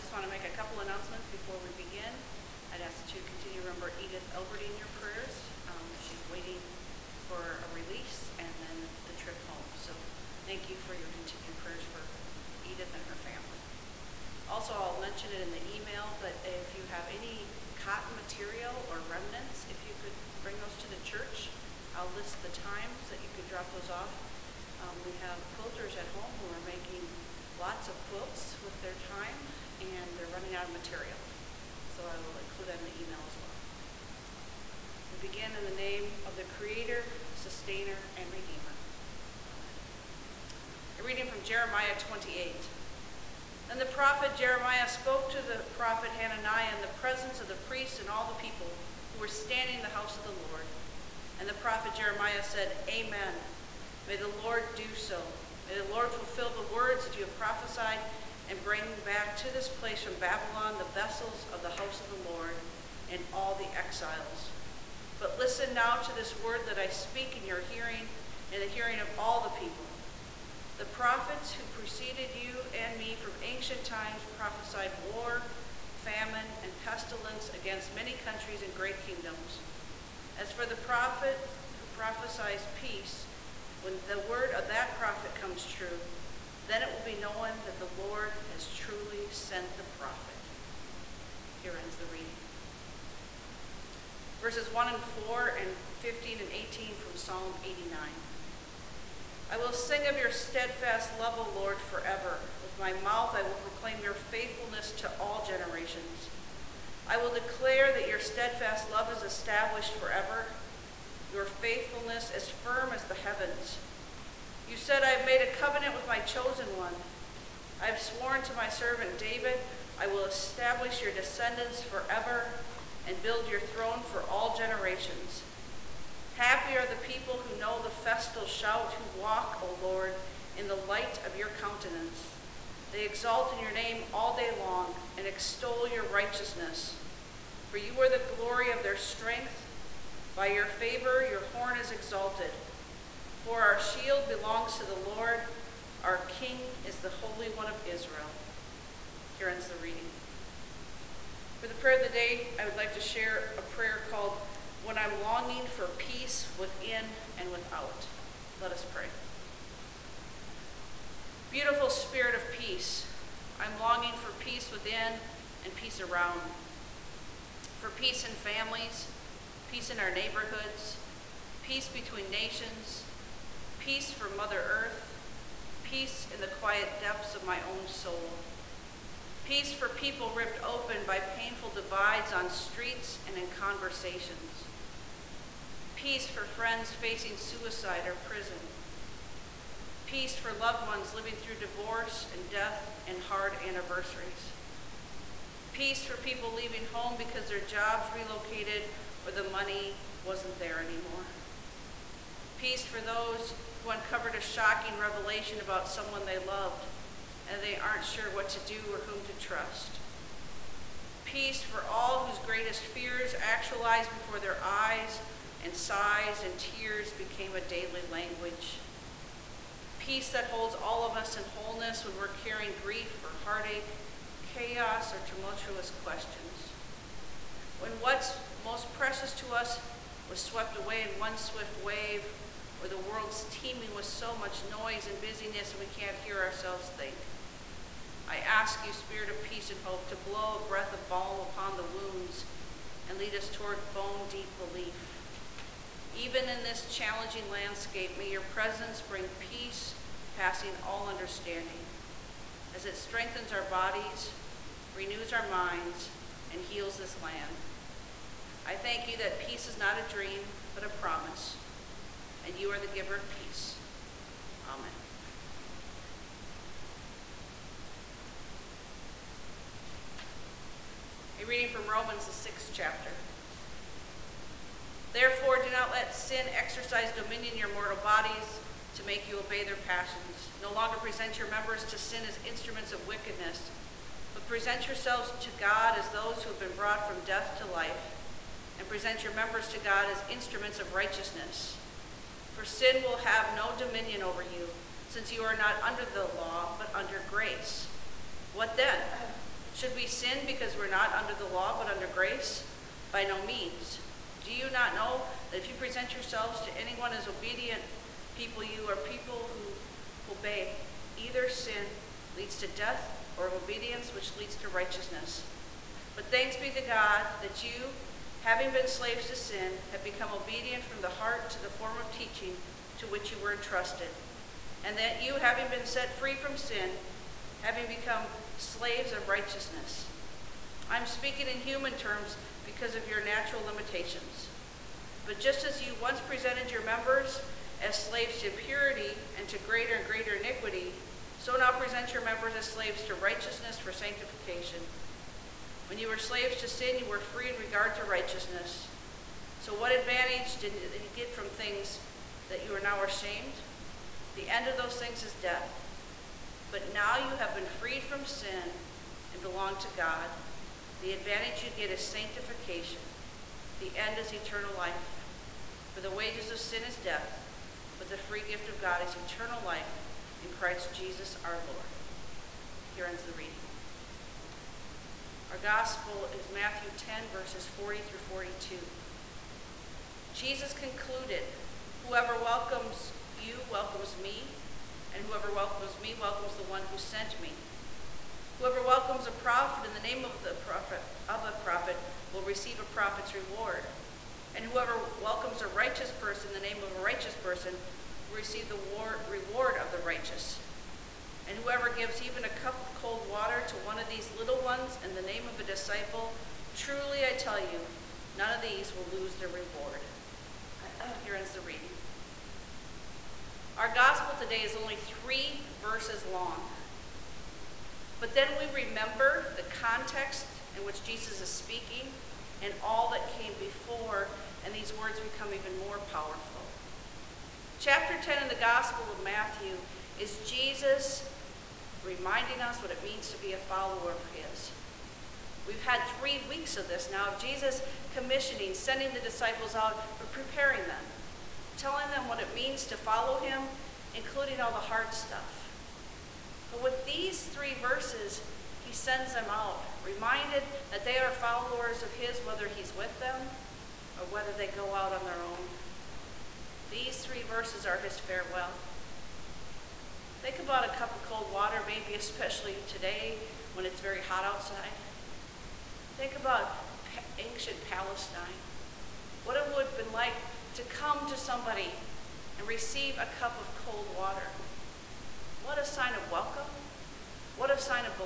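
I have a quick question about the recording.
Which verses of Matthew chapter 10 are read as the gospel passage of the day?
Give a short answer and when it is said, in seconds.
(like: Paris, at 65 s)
40 through 42, at 377 s.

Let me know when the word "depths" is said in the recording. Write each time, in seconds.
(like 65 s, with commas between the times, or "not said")
177 s.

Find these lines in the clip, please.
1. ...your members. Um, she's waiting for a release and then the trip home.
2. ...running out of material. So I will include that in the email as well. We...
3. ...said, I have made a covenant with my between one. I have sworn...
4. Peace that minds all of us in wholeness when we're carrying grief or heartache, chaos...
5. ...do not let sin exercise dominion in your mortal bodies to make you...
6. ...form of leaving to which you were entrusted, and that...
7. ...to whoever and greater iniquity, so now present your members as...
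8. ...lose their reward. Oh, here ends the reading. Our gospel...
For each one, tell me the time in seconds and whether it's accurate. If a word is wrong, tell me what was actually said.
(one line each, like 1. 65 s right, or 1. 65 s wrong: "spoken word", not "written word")
1. 4 s wrong: "prayers", not "members"
2. 30 s right
3. 114 s wrong: "chosen", not "between"
4. 219 s wrong: "holds", not "minds"
5. 275 s right
6. 321 s wrong: "teaching", not "leaving"
7. 339 s wrong: "greater", not "whoever"
8. 409 s right.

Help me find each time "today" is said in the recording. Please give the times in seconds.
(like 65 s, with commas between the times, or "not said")
414 s, 462 s.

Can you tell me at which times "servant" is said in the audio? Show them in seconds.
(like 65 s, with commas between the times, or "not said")
118 s.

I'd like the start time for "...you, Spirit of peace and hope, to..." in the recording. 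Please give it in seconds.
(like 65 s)
238 s.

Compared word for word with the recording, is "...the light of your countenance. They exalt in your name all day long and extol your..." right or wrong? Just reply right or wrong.
right.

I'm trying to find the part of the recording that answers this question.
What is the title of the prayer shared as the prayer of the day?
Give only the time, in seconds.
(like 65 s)
154 s.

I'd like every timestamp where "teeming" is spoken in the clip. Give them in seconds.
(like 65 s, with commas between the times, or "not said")
233 s.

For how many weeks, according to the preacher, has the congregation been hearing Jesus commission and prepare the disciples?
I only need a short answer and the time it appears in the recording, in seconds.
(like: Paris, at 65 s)
3, at 436 s.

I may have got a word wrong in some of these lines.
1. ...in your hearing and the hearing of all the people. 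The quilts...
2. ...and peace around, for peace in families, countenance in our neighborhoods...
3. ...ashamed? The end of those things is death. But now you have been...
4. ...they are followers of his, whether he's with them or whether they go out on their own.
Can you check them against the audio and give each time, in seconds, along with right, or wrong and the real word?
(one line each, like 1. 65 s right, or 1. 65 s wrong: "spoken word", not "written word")
1. 67 s wrong: "prophets", not "quilts"
2. 165 s wrong: "peace", not "countenance"
3. 353 s right
4. 451 s right.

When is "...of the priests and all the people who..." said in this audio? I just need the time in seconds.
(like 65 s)
47 s.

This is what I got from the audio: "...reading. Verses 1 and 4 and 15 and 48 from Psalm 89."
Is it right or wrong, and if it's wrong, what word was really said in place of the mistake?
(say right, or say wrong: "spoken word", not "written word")
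wrong: "18", not "48".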